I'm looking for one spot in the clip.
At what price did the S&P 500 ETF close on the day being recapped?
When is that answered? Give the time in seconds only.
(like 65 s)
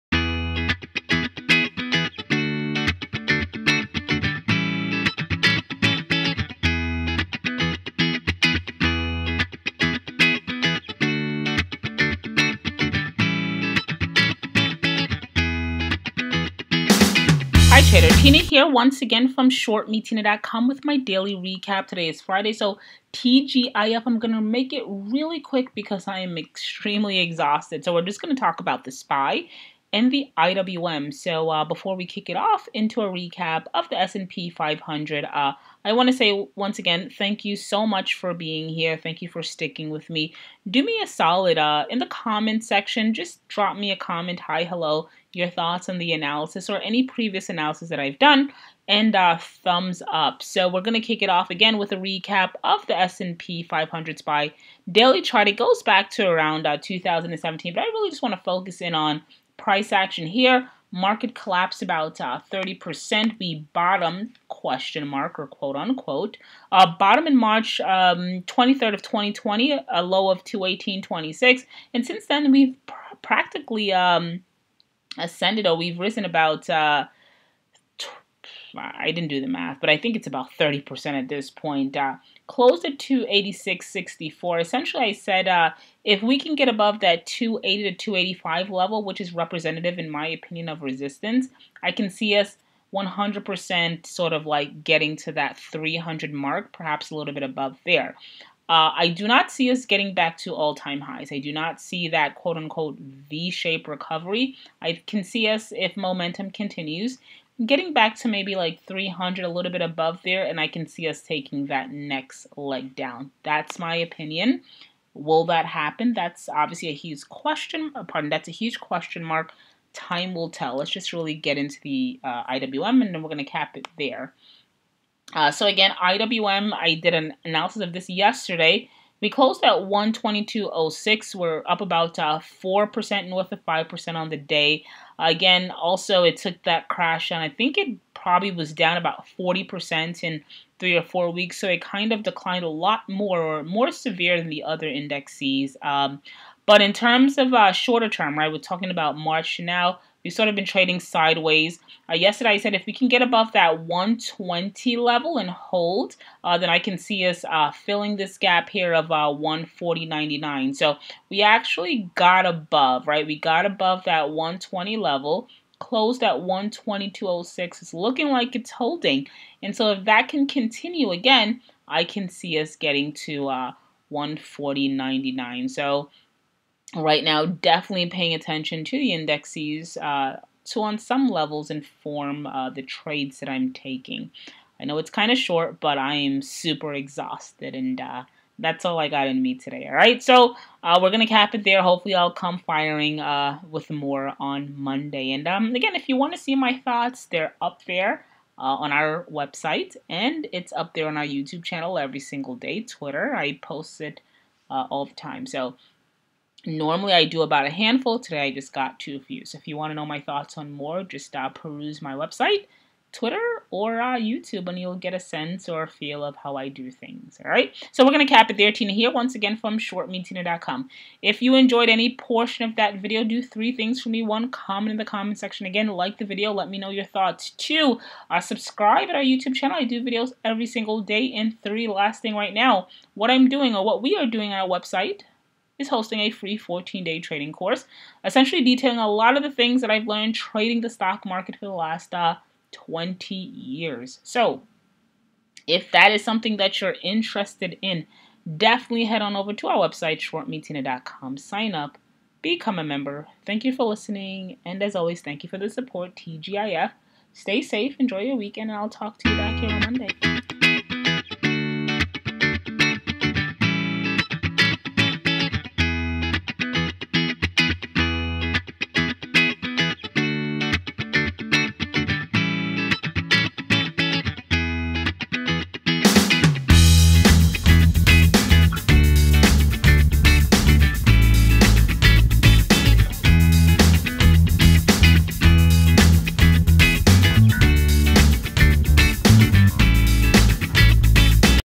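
82 s.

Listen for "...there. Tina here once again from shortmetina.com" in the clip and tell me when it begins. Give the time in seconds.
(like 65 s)
218 s.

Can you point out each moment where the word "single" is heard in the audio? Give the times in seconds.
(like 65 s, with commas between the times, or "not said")
202 s, 230 s.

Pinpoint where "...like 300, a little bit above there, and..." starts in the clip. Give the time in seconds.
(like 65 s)
108 s.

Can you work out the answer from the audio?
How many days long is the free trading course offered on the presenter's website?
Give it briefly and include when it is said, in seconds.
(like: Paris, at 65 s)
14 days, at 236 s.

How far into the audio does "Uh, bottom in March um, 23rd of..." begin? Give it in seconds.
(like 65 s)
66 s.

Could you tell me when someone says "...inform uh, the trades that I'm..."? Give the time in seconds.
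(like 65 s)
181 s.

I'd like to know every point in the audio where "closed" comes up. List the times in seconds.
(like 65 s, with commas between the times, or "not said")
82 s, 129 s, 165 s.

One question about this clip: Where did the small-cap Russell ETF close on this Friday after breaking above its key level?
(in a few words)
122.06.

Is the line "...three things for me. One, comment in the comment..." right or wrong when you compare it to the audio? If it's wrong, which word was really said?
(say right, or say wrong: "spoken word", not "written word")
right.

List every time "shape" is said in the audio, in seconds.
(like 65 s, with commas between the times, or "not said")
103 s.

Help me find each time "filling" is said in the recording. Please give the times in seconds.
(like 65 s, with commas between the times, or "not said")
157 s.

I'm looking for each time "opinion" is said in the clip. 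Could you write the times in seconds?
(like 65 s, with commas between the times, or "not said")
90 s, 113 s.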